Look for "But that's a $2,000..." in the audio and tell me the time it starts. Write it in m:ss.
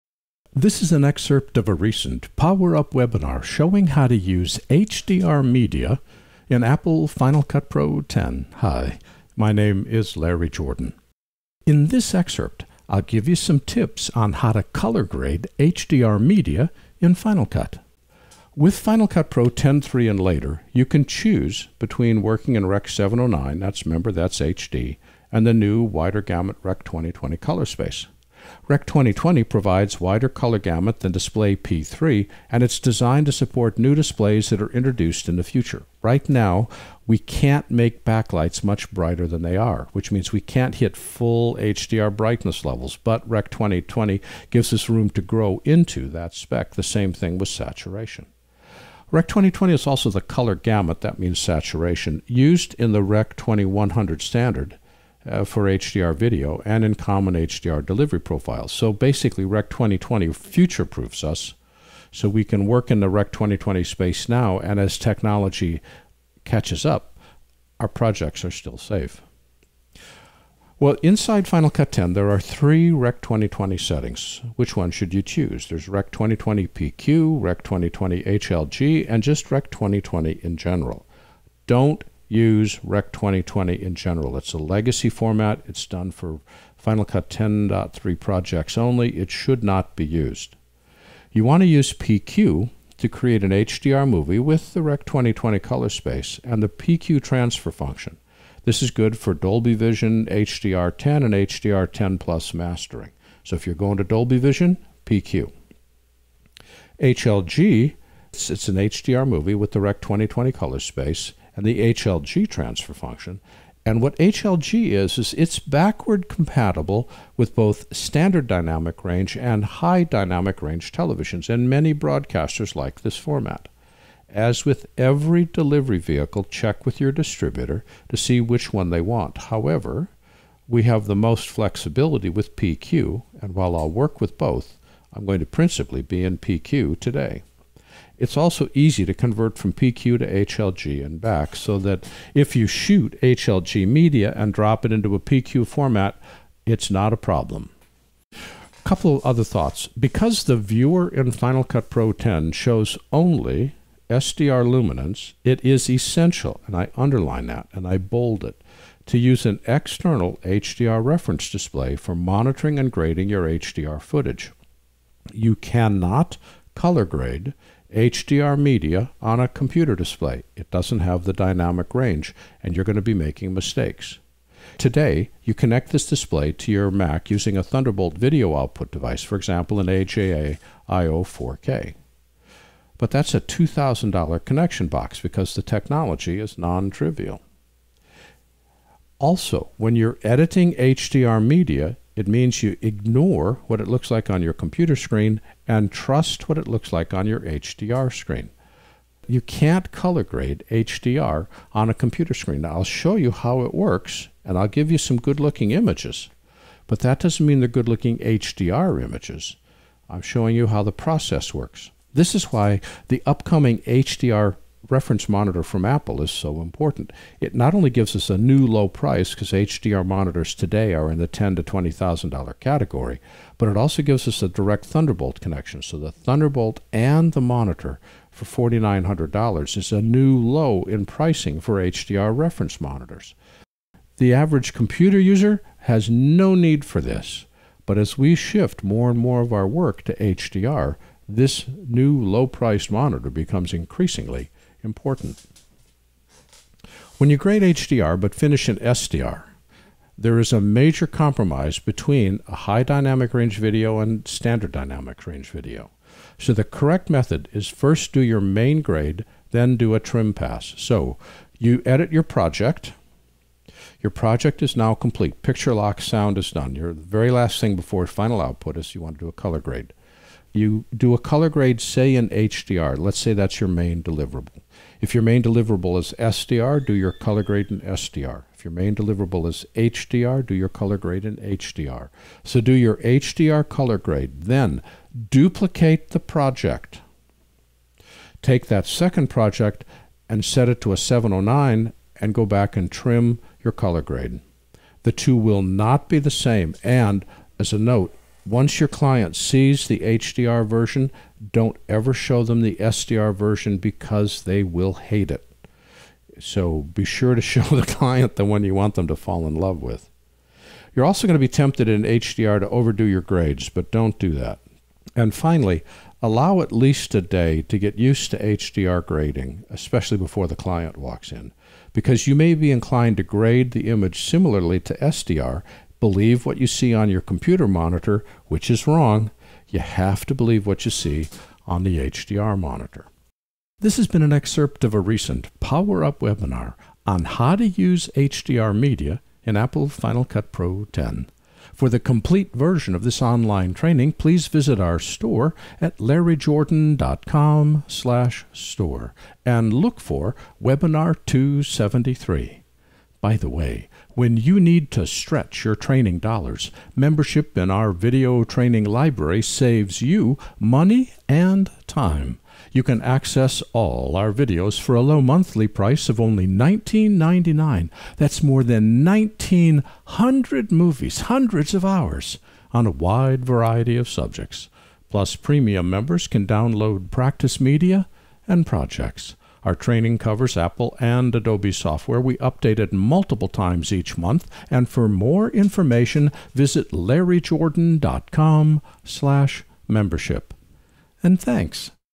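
3:02.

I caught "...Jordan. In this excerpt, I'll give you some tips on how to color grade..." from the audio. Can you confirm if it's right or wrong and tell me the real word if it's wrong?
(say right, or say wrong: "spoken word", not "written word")
right.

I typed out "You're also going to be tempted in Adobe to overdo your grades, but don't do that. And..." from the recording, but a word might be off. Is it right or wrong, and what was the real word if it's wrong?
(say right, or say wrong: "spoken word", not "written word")
wrong: "HDR", not "Adobe".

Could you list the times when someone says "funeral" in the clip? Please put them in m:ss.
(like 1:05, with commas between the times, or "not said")
not said.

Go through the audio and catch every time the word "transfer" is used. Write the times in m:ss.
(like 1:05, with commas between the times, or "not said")
1:37, 1:52.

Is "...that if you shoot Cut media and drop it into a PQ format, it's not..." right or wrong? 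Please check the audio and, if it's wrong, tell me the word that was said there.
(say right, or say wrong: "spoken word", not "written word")
wrong: "HLG", not "Cut".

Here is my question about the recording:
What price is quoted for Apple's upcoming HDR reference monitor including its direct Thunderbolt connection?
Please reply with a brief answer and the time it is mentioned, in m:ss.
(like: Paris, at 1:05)
$4,900, at 3:48.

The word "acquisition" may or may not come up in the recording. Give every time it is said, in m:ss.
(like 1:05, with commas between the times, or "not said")
not said.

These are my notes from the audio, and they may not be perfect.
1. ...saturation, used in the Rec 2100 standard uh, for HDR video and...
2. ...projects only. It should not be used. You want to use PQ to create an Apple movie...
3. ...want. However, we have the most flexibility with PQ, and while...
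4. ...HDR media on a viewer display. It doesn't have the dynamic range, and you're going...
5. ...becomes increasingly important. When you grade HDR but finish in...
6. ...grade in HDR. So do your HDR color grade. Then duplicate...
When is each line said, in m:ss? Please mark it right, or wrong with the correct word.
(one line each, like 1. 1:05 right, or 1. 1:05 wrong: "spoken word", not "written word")
1. 0:51 right
2. 1:28 wrong: "HDR", not "Apple"
3. 2:09 right
4. 2:47 wrong: "computer", not "viewer"
5. 4:03 right
6. 4:40 right.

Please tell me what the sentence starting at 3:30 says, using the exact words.
I'm showing you how the process works.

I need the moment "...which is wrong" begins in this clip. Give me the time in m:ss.
5:28.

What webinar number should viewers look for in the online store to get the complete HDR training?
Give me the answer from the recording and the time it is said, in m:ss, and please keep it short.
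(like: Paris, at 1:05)
273, at 5:50.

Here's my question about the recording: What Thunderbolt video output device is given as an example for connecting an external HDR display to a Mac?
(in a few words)
AJA IO 4K.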